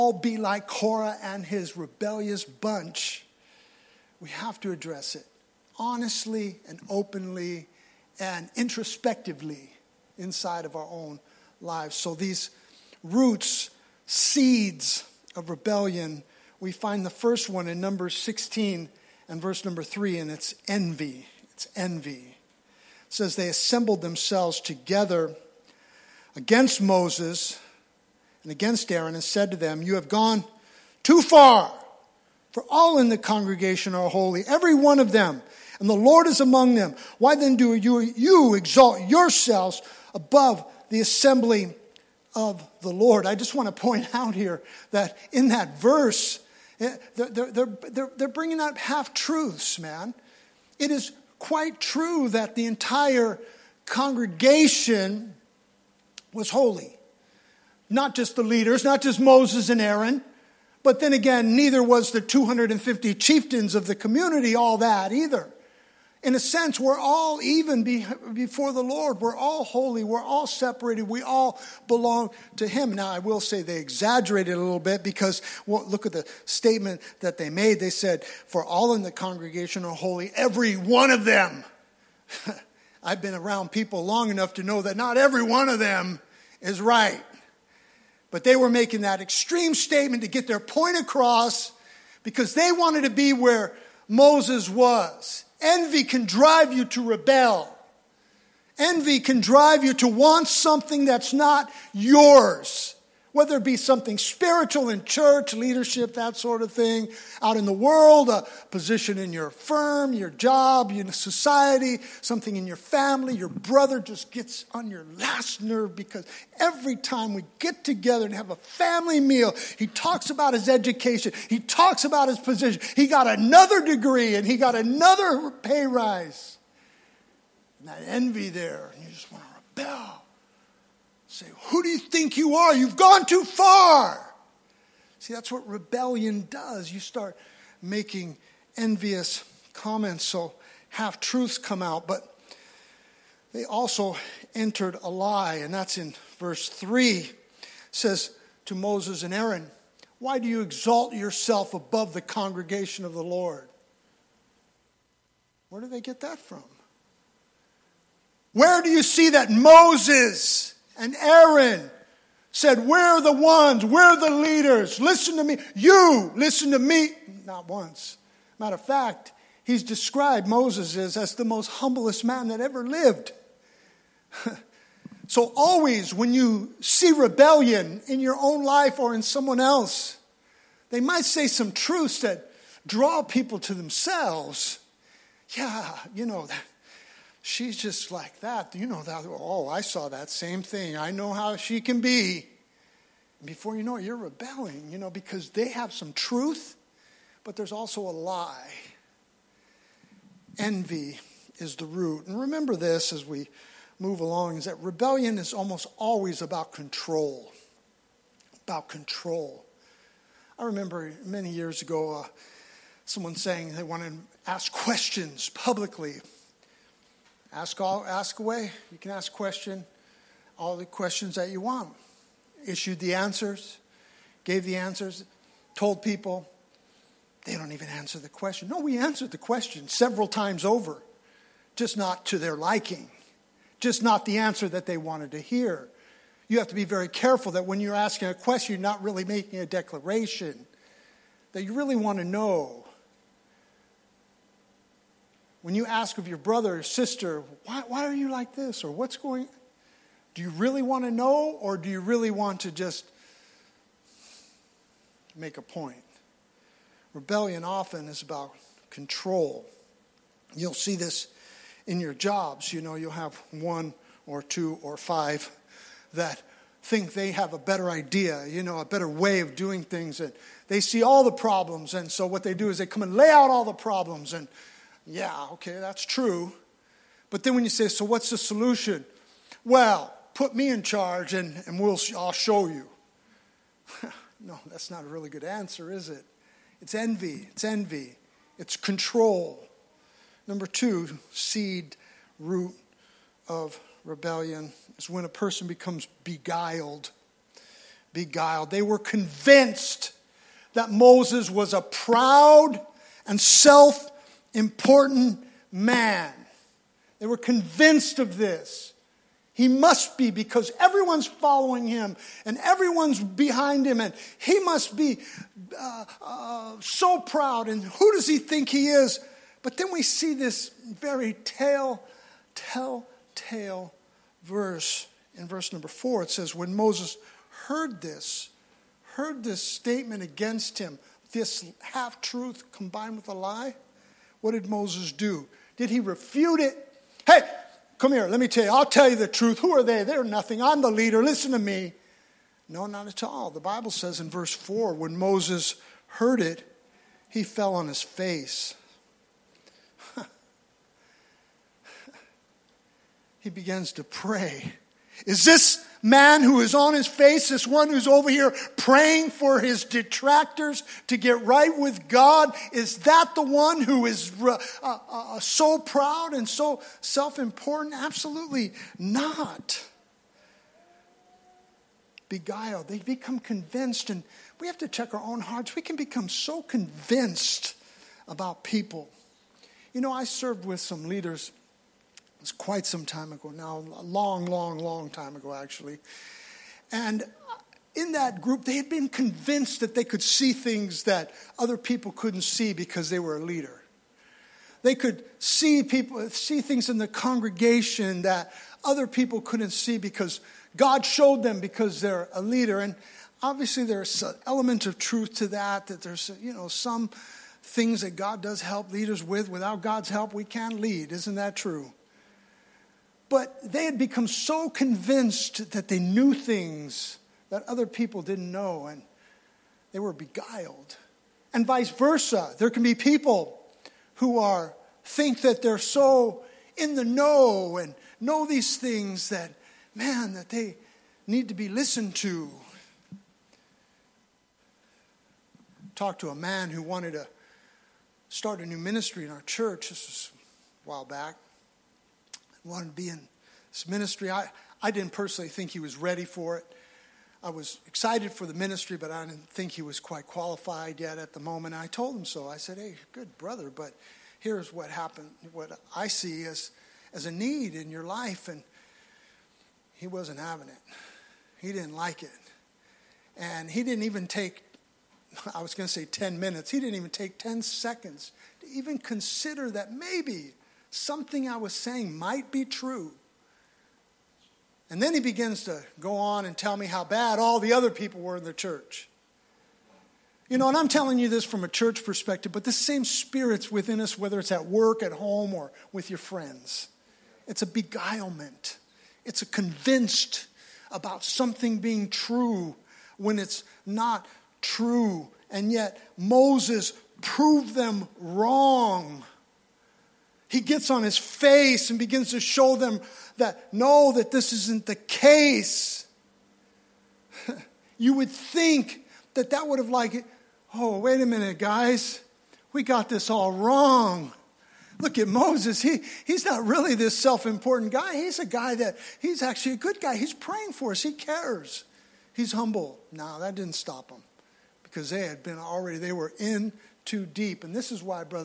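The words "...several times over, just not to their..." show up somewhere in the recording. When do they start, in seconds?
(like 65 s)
229 s.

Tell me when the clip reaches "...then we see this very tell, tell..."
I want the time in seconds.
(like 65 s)
319 s.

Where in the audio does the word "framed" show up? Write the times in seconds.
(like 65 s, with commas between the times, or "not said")
not said.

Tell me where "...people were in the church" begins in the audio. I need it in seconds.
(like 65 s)
477 s.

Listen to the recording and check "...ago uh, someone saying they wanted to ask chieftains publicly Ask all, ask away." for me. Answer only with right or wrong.
wrong.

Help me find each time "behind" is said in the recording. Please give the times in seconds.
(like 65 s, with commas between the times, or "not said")
313 s.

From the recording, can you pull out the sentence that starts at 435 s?
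Talked to a man who wanted to start a new ministry in our church.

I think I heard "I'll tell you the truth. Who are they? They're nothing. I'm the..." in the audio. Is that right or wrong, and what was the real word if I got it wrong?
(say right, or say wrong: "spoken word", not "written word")
right.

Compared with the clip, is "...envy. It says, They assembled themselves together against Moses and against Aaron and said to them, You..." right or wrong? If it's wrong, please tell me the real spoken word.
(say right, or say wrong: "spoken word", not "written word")
right.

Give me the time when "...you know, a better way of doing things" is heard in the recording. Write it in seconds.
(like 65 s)
268 s.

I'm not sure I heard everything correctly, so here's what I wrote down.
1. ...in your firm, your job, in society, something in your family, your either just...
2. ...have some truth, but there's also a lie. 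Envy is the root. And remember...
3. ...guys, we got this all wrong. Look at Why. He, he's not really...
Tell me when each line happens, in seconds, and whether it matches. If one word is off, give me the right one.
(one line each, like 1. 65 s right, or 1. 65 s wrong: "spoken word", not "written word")
1. 109 s wrong: "brother", not "either"
2. 195 s right
3. 511 s wrong: "Moses", not "Why".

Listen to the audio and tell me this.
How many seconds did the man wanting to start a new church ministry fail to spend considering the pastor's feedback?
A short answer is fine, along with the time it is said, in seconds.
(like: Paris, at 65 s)
10, at 467 s.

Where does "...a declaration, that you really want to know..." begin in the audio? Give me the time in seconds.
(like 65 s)
239 s.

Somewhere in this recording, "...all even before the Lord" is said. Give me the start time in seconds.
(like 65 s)
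66 s.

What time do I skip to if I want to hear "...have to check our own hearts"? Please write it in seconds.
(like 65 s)
374 s.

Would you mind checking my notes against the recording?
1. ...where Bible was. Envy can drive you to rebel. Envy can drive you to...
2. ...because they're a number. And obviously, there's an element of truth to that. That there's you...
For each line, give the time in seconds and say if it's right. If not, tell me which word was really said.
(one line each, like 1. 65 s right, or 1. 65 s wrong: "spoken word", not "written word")
1. 93 s wrong: "Moses", not "Bible"
2. 401 s wrong: "leader", not "number".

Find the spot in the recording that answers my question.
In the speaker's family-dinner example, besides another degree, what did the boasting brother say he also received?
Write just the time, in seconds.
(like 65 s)
124 s.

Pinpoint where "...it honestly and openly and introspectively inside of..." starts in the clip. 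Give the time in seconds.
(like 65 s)
5 s.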